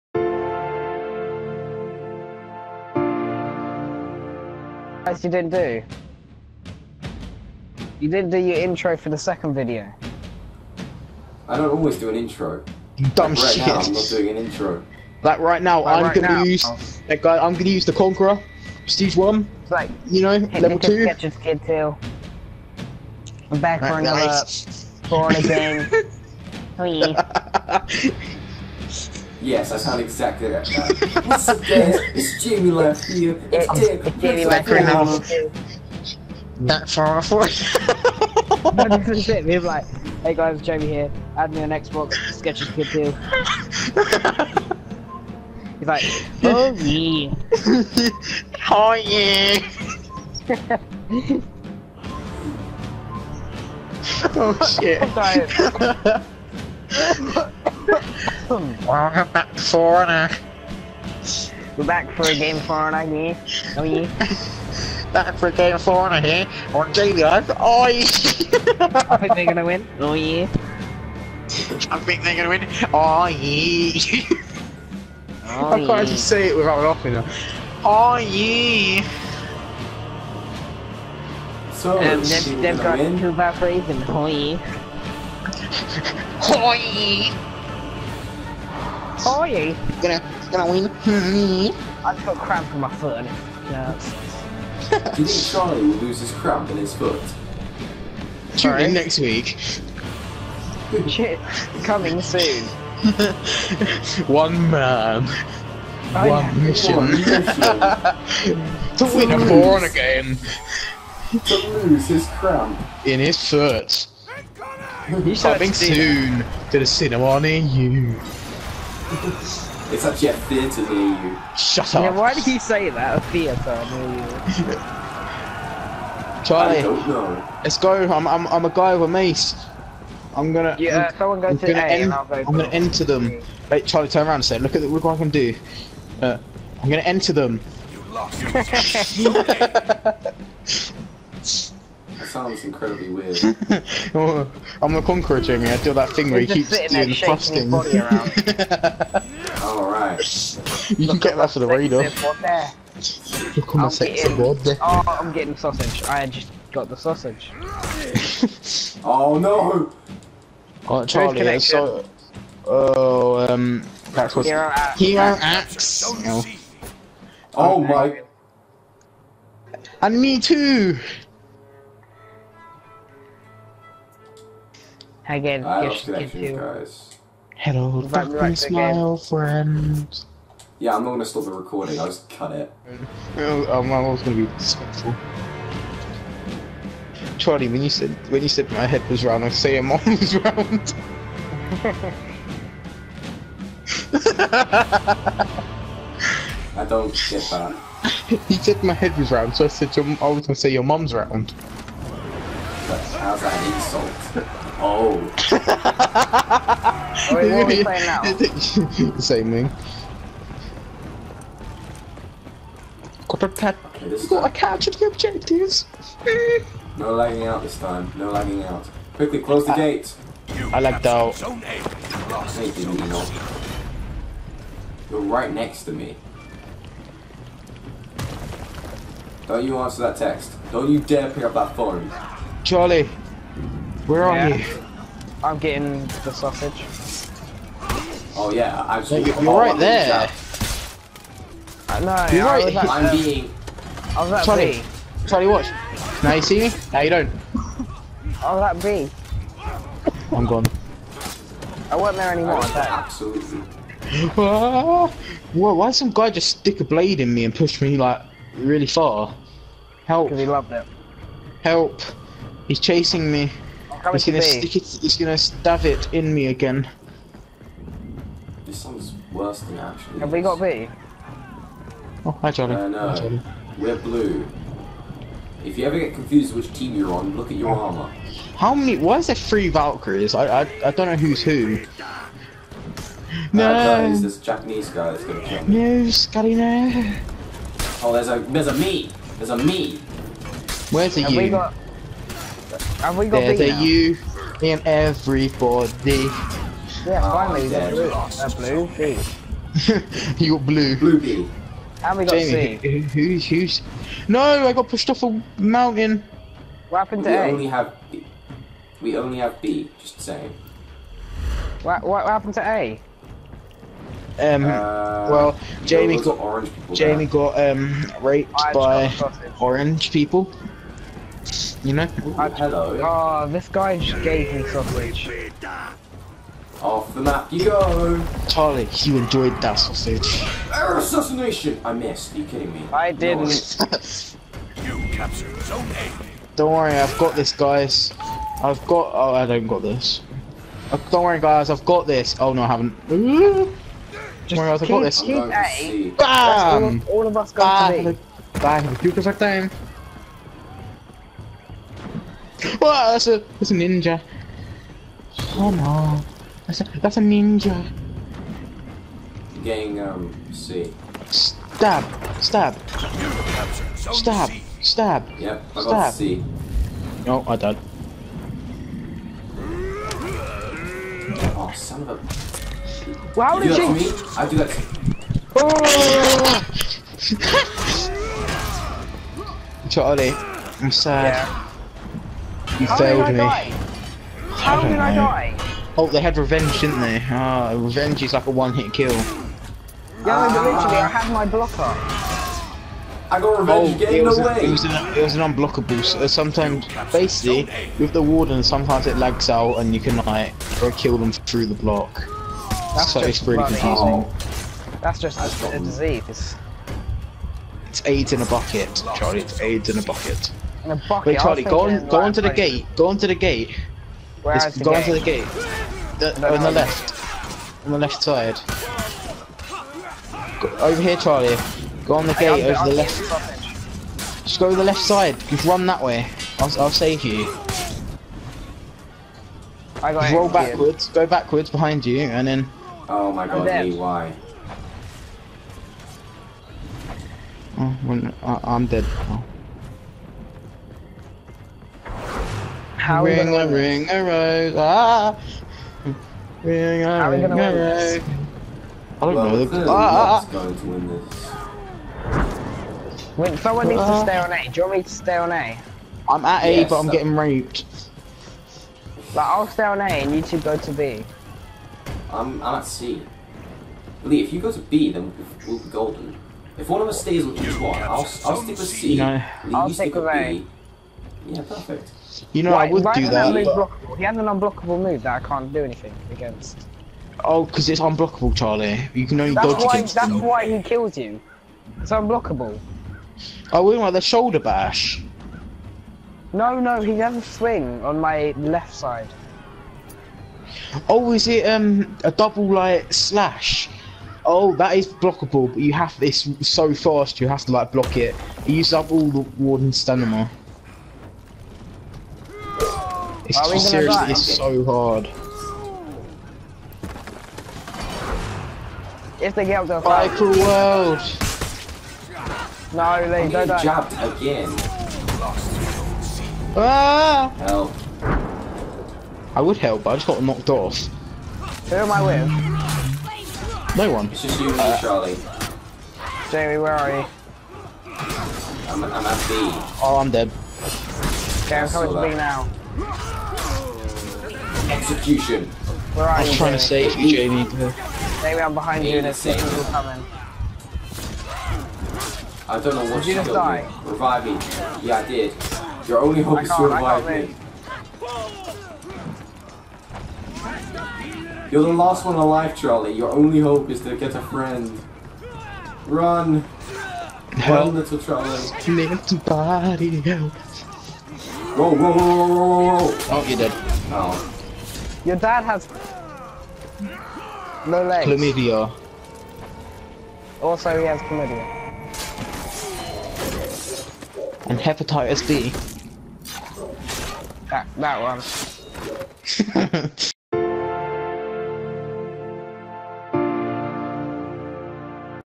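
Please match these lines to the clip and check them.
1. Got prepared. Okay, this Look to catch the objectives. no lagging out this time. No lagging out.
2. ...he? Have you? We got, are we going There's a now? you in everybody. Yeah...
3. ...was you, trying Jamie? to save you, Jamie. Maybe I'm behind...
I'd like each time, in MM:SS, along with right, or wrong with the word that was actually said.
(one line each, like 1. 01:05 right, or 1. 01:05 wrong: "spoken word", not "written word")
1. 03:33 wrong: "Got", not "Look"
2. 04:51 right
3. 08:56 right.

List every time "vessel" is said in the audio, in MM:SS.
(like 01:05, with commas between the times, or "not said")
not said.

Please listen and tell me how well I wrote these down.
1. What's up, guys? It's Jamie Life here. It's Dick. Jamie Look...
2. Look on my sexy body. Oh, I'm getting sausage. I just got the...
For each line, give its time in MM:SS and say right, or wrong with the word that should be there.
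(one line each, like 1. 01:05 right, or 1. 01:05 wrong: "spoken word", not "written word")
1. 00:31 wrong: "Life", not "Look"
2. 02:33 right.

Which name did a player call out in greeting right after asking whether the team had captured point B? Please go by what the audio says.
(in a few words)
Johnny.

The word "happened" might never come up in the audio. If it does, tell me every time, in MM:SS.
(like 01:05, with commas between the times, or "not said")
05:06, 05:12.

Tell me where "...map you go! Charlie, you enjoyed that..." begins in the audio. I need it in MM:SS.
05:27.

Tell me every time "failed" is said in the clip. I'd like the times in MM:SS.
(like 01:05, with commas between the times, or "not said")
06:22.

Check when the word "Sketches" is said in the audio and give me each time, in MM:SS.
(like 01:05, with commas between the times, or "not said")
00:42.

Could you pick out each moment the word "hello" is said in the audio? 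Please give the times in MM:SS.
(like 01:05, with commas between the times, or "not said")
02:57, 05:22.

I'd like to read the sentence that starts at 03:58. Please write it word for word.
Oh yeah, I'm so You're right there.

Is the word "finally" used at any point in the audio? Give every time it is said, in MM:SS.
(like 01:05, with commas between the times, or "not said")
04:57.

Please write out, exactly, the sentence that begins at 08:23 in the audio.
It's Are just, seriously, it's so hard.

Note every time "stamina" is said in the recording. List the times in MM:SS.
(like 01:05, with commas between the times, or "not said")
08:20.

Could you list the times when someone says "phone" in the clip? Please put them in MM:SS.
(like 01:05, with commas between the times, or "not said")
03:51.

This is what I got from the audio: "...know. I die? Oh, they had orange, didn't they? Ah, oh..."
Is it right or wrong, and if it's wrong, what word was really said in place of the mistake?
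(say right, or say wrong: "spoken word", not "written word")
wrong: "revenge", not "orange".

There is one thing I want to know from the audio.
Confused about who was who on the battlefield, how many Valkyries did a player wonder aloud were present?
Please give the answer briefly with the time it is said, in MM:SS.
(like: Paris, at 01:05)
3, at 04:39.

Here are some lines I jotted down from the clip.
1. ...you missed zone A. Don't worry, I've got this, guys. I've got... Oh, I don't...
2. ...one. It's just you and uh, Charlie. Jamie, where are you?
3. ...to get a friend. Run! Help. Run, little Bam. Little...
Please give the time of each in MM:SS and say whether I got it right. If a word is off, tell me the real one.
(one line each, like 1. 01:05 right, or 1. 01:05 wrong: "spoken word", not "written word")
1. 05:34 wrong: "captured", not "missed"
2. 08:44 right
3. 09:14 wrong: "Charlie", not "Bam".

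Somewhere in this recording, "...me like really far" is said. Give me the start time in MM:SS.
04:17.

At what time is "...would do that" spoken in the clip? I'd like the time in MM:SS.
07:52.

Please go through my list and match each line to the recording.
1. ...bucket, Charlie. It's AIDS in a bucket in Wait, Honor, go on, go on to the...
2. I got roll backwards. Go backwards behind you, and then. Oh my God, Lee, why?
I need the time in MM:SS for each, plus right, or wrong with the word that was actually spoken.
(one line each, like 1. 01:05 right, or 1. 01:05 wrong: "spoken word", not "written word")
1. 06:48 wrong: "Charlie", not "Honor"
2. 07:10 right.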